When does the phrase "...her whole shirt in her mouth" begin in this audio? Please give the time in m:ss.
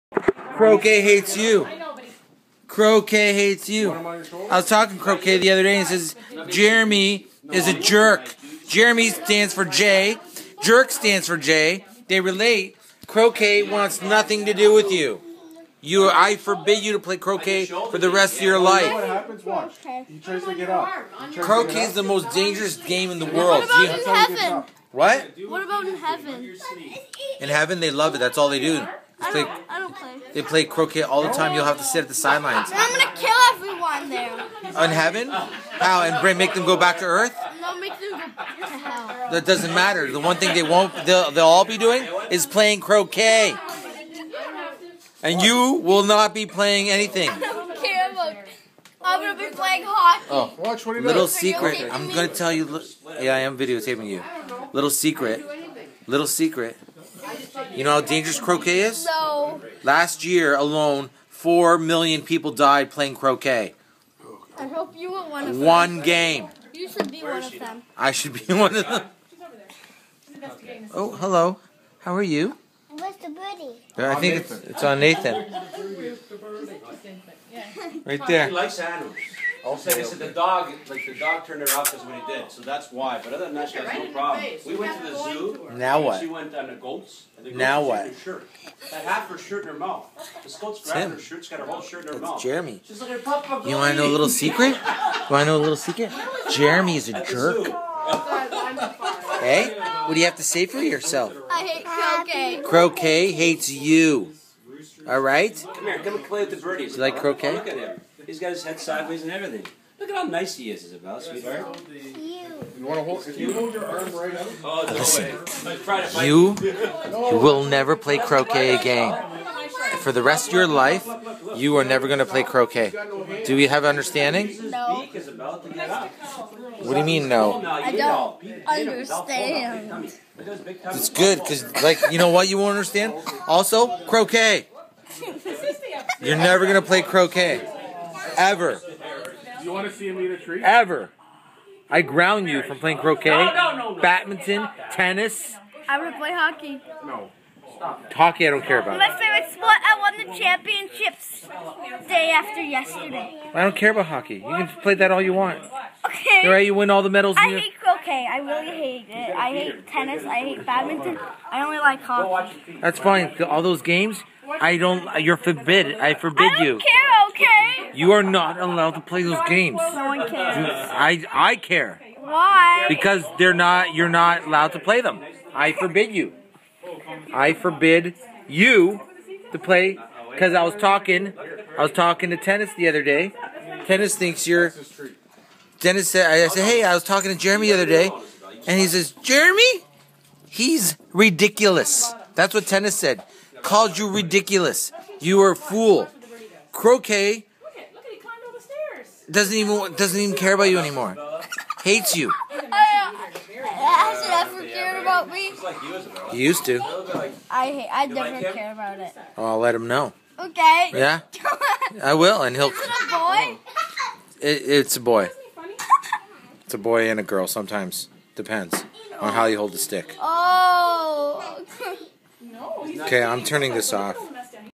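1:31.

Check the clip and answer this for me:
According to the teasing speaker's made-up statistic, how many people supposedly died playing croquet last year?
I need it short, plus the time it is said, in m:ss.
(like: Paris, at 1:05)
4 million, at 1:01.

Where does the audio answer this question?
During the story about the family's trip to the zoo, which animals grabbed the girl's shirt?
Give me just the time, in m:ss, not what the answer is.
1:26.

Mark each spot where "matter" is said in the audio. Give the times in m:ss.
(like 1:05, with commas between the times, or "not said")
0:39.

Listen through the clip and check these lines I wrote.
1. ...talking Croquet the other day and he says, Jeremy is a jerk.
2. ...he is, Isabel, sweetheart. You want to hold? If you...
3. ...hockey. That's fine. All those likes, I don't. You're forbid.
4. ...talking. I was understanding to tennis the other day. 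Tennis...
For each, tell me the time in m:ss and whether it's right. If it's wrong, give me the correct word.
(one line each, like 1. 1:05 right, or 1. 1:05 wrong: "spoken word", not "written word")
1. 0:04 right
2. 1:50 right
3. 2:42 wrong: "games", not "likes"
4. 3:00 wrong: "talking", not "understanding".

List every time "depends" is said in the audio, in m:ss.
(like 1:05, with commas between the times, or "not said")
3:38.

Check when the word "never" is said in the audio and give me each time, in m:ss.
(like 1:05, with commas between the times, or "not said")
1:57, 2:01, 2:16, 3:28.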